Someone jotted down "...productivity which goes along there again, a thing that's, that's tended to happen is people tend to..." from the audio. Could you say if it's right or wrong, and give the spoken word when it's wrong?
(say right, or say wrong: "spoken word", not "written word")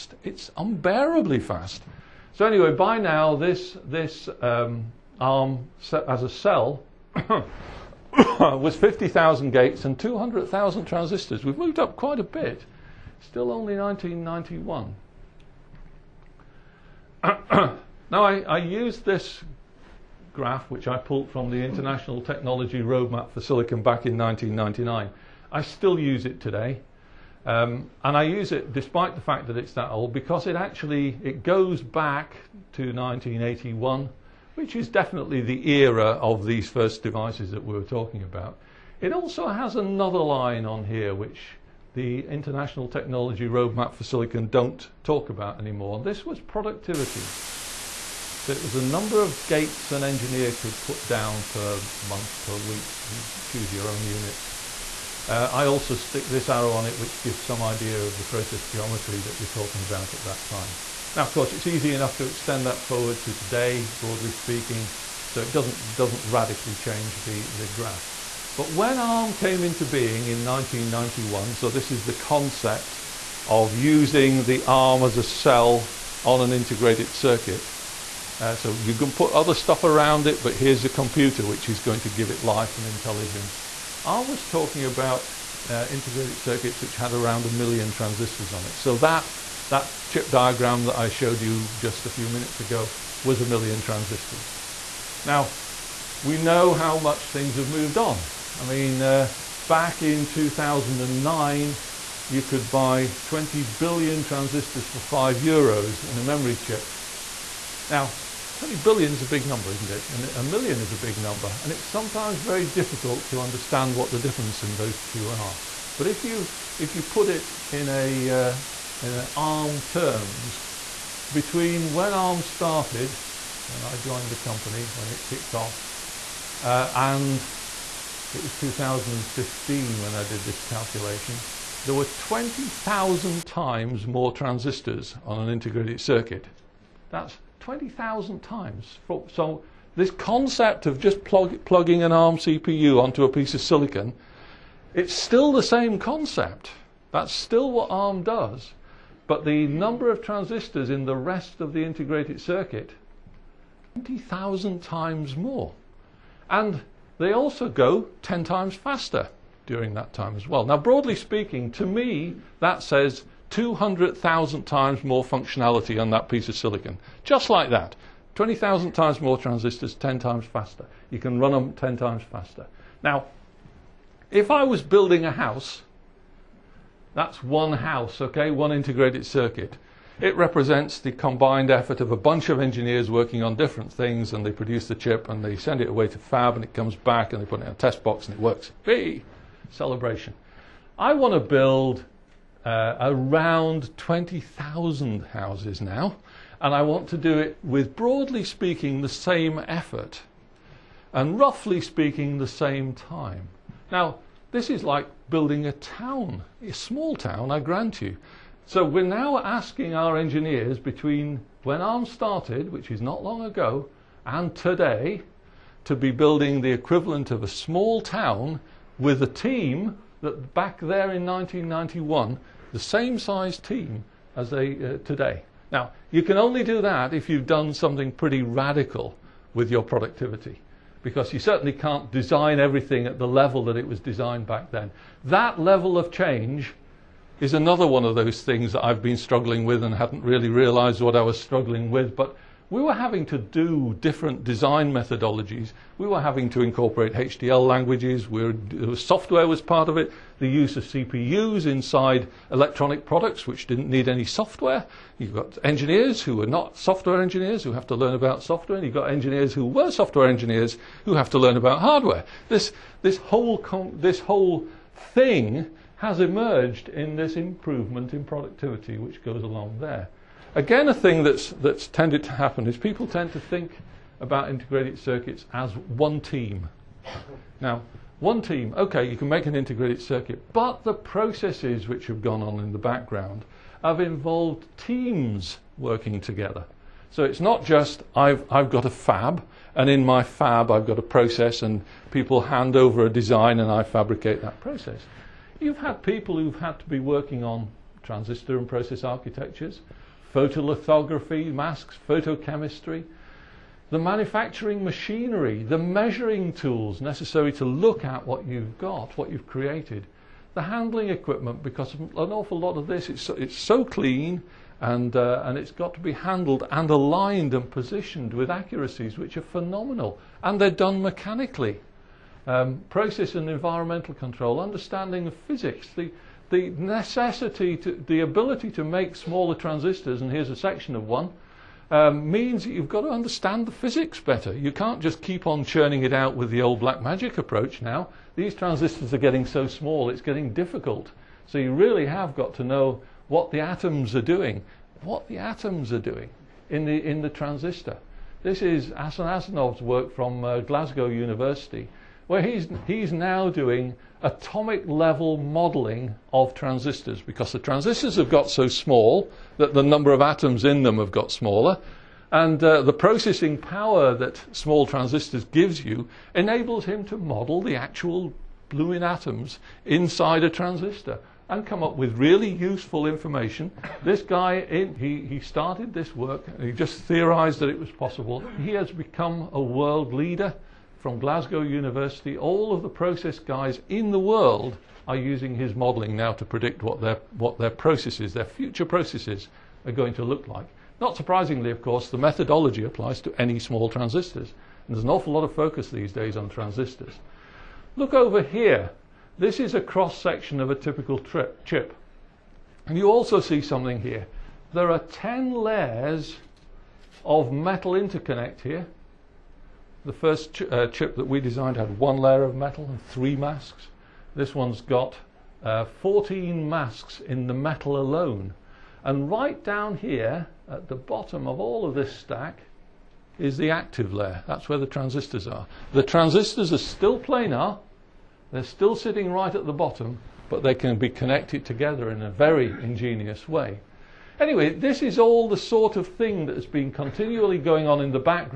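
right.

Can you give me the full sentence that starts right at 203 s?
Now, this is like building a town, a small town, I grant you.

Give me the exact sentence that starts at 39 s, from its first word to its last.
It also has another line on here which the International Technology Roadmap for Silicon don't talk about anymore.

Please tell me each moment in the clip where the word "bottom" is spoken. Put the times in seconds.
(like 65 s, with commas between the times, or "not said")
420 s, 429 s.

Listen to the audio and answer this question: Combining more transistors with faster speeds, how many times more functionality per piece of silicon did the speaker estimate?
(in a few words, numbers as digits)
200,000.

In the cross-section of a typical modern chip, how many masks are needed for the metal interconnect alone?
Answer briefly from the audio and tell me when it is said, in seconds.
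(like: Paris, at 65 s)
14, at 415 s.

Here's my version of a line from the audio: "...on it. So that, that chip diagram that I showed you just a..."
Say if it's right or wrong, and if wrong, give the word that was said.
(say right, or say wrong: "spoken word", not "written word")
right.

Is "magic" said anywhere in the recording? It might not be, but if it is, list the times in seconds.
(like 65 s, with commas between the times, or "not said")
337 s.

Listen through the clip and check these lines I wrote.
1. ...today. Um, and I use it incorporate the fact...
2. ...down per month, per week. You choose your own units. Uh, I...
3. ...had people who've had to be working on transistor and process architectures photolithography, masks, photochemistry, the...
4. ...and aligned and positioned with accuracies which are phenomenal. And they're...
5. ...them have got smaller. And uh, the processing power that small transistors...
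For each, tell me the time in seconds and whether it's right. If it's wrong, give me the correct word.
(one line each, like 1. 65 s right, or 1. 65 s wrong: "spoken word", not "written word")
1. 26 s wrong: "despite", not "incorporate"
2. 51 s right
3. 295 s right
4. 316 s right
5. 360 s right.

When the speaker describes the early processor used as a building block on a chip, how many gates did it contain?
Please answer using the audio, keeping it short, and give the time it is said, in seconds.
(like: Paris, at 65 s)
50,000, at 8 s.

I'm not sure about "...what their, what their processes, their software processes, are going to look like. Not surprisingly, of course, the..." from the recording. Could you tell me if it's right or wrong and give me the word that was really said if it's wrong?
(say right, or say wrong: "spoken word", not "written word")
wrong: "future", not "software".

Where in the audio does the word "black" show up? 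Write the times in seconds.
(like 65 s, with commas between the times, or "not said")
336 s.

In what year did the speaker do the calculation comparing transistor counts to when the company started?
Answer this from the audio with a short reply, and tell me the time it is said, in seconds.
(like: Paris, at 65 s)
2015, at 128 s.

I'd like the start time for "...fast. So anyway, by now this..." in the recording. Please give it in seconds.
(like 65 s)
1 s.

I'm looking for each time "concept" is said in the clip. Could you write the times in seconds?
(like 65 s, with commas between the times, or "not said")
72 s, 140 s, 145 s.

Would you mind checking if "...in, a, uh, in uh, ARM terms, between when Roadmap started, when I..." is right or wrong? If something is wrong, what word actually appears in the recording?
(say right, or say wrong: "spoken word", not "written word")
wrong: "ARM", not "Roadmap".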